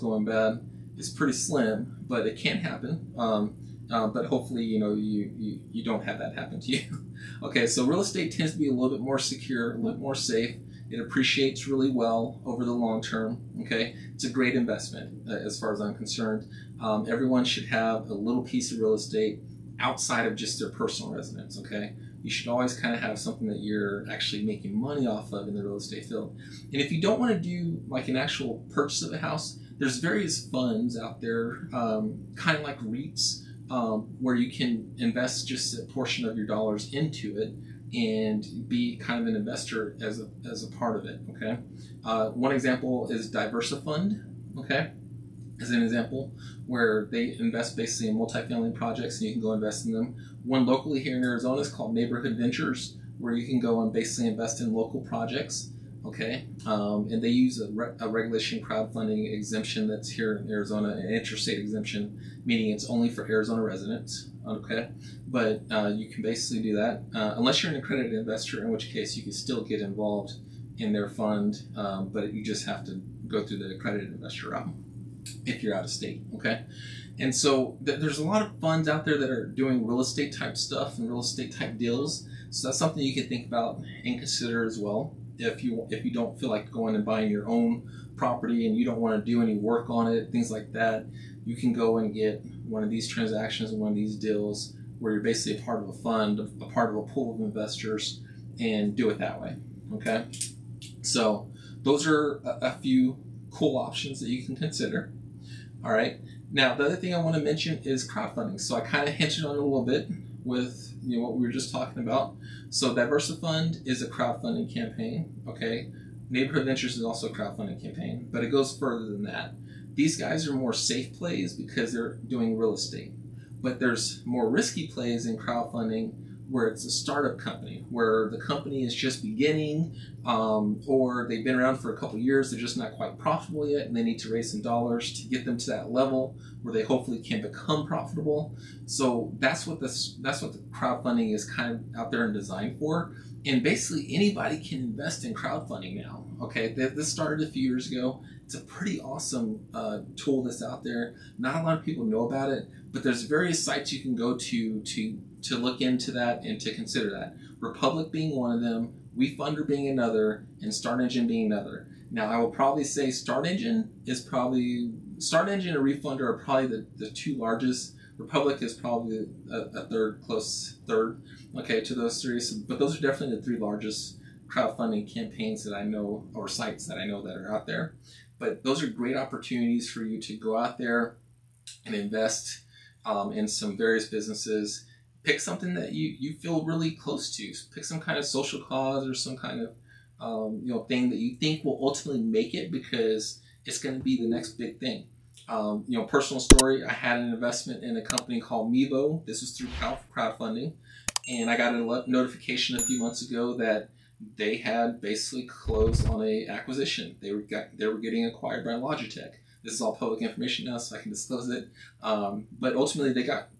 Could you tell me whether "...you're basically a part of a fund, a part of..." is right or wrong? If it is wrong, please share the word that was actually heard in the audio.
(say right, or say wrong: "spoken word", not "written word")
right.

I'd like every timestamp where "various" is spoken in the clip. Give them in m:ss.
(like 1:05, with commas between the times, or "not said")
0:29, 2:33, 3:03.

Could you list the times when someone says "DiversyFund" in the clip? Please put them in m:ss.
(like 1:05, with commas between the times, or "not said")
0:43, 1:52.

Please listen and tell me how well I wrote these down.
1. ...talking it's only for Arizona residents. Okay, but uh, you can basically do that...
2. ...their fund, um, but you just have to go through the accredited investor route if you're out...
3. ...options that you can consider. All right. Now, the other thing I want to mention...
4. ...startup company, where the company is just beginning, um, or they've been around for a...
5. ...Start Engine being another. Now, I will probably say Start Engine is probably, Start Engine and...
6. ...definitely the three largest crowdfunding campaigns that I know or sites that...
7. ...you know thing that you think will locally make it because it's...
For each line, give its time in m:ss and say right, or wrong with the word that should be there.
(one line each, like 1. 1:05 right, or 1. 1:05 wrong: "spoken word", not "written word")
1. 1:02 wrong: "meaning", not "talking"
2. 1:10 right
3. 1:43 right
4. 2:06 right
5. 2:40 right
6. 2:53 right
7. 3:10 wrong: "ultimately", not "locally".